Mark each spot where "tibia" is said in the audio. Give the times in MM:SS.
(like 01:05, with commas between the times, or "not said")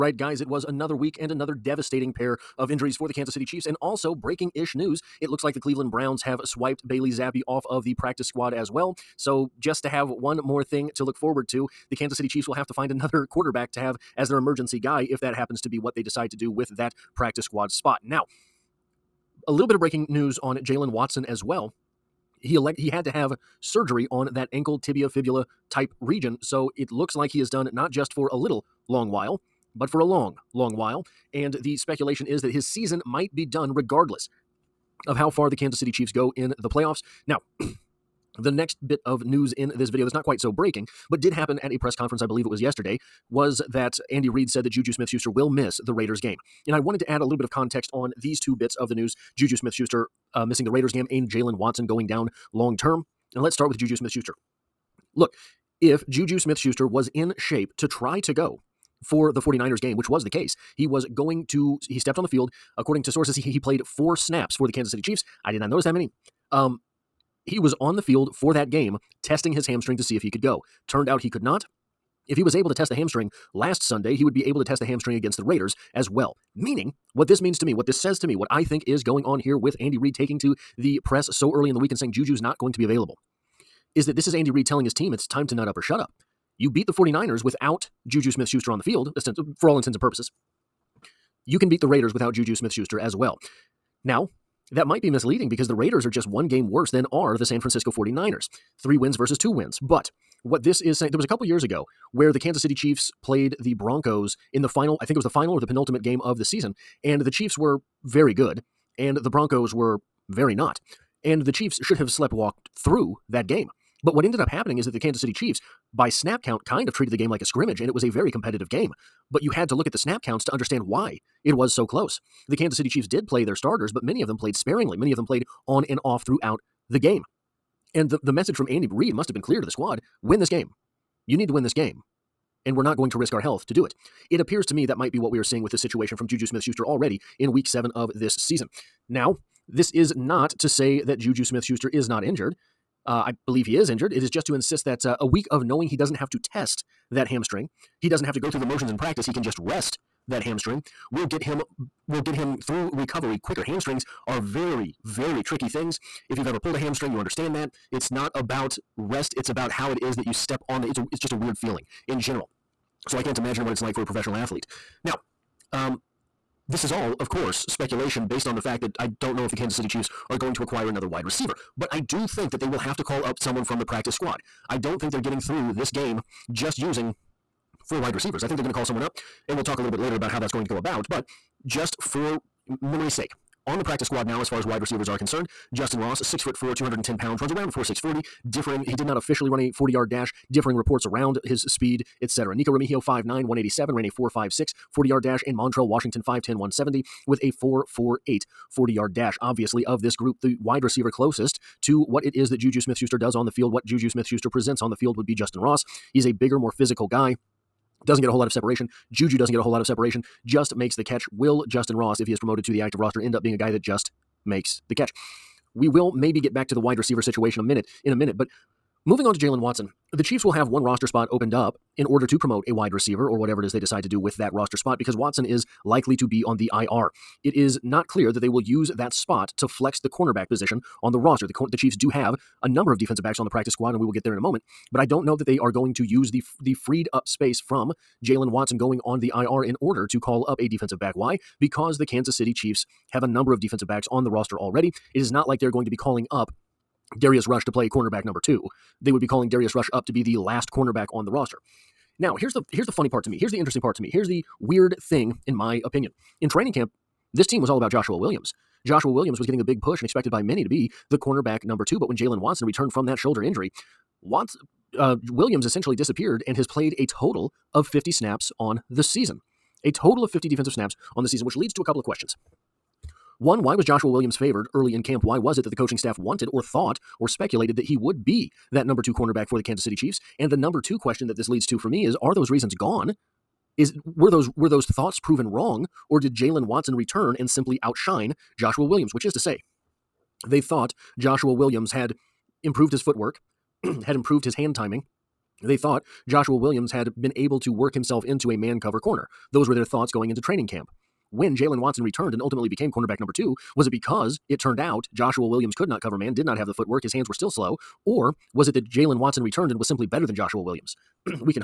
00:24.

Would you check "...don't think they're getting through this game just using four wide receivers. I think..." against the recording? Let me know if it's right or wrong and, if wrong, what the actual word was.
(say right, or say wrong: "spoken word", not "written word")
right.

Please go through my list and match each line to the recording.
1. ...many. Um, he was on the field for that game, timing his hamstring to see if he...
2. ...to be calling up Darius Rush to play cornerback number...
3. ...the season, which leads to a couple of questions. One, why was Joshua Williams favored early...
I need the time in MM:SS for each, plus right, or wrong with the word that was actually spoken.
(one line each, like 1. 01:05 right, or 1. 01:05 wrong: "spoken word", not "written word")
1. 01:05 wrong: "testing", not "timing"
2. 04:05 right
3. 04:31 right.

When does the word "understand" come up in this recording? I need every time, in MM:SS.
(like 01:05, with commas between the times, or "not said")
02:00, 02:37.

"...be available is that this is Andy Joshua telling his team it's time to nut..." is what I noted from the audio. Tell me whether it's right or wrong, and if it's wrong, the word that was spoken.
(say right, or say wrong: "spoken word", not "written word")
wrong: "Reid", not "Joshua".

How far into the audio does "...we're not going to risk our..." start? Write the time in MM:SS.
02:12.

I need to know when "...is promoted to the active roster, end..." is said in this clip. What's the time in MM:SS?
03:32.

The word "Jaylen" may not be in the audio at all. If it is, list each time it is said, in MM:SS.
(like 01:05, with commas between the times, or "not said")
00:20, 00:51, 03:39, 03:58, 04:22.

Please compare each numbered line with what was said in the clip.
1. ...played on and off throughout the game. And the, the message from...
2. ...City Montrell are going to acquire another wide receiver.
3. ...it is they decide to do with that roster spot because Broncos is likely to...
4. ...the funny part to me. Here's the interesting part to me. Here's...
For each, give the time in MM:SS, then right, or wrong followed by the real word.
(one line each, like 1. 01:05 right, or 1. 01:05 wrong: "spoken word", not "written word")
1. 02:05 right
2. 02:49 wrong: "Chiefs", not "Montrell"
3. 03:43 wrong: "Watson", not "Broncos"
4. 04:12 right.